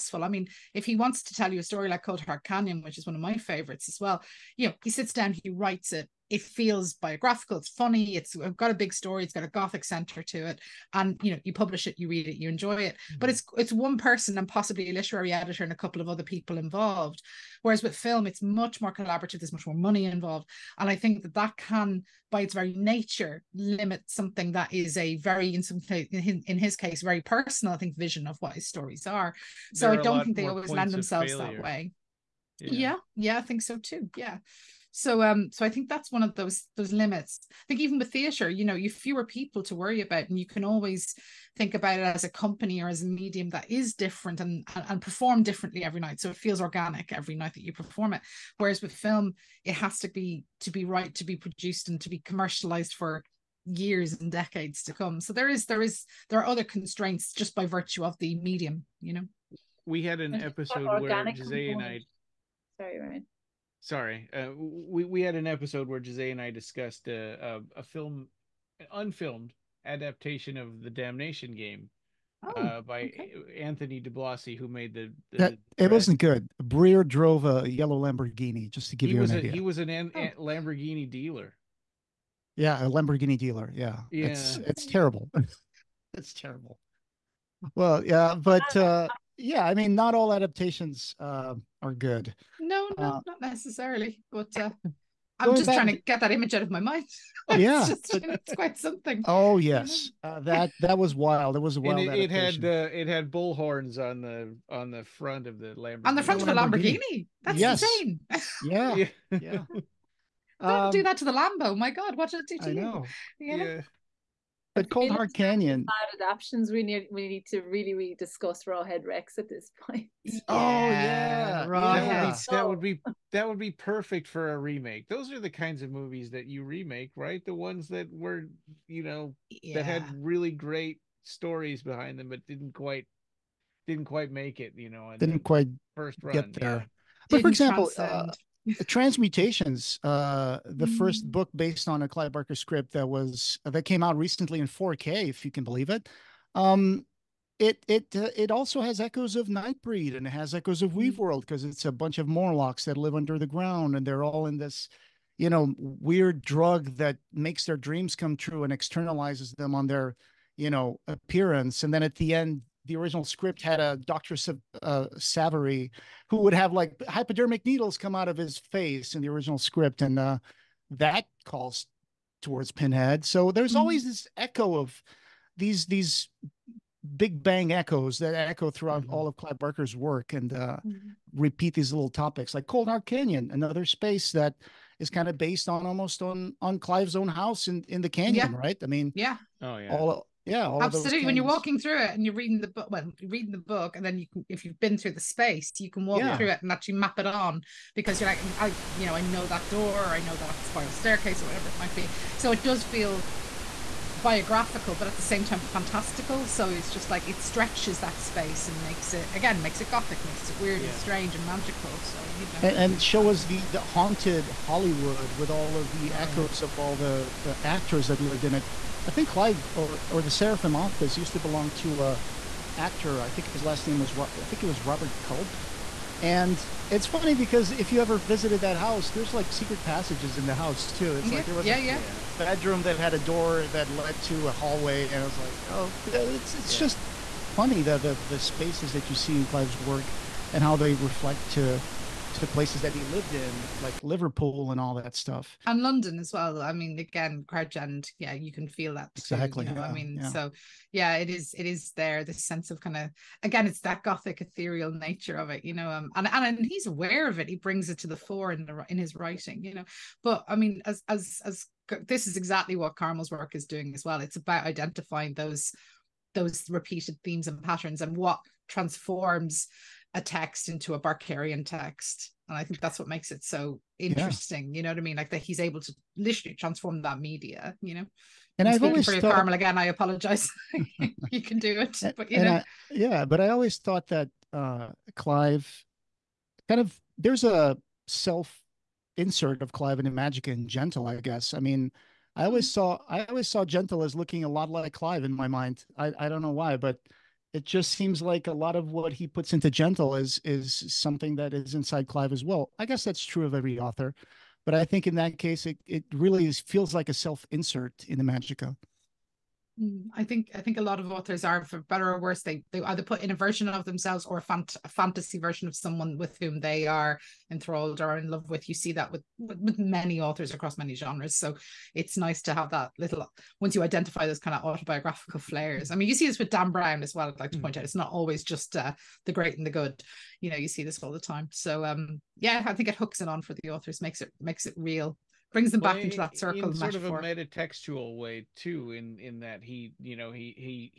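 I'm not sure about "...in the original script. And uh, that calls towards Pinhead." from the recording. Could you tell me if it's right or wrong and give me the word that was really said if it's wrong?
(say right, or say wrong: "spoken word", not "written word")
right.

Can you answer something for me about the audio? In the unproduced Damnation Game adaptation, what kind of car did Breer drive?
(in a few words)
yellow Lamborghini.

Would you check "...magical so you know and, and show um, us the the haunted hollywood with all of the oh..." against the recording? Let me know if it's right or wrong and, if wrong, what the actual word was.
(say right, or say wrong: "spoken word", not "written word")
right.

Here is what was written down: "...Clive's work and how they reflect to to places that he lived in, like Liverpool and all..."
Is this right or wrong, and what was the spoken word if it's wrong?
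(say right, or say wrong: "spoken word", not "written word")
right.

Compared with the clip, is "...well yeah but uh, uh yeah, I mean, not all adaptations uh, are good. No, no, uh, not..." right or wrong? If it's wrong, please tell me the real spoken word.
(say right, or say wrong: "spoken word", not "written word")
right.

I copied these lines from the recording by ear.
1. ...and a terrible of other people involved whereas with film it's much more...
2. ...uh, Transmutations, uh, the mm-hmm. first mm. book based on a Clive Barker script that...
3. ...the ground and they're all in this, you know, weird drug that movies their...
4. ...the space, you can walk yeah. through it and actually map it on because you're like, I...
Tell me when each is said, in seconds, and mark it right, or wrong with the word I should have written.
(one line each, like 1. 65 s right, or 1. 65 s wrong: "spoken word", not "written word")
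1. 15 s wrong: "couple", not "terrible"
2. 138 s right
3. 153 s wrong: "makes", not "movies"
4. 195 s right.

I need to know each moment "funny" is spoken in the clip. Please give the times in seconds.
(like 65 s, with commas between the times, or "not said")
7 s, 227 s, 237 s.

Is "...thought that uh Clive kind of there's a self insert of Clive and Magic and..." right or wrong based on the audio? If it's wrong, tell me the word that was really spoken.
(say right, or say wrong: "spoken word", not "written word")
right.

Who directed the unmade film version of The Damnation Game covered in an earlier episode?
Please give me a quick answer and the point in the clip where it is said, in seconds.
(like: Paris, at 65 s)
Anthony DiBlasi, at 73 s.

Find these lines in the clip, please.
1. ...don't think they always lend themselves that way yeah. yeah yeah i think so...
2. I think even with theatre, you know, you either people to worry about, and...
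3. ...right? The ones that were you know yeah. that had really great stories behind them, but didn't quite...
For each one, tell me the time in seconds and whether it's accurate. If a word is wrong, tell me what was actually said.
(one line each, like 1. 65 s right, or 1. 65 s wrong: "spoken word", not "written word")
1. 29 s right
2. 37 s wrong: "fewer", not "either"
3. 127 s right.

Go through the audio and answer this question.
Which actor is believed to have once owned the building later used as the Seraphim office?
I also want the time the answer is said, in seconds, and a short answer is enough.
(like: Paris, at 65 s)
Robert Culp, at 224 s.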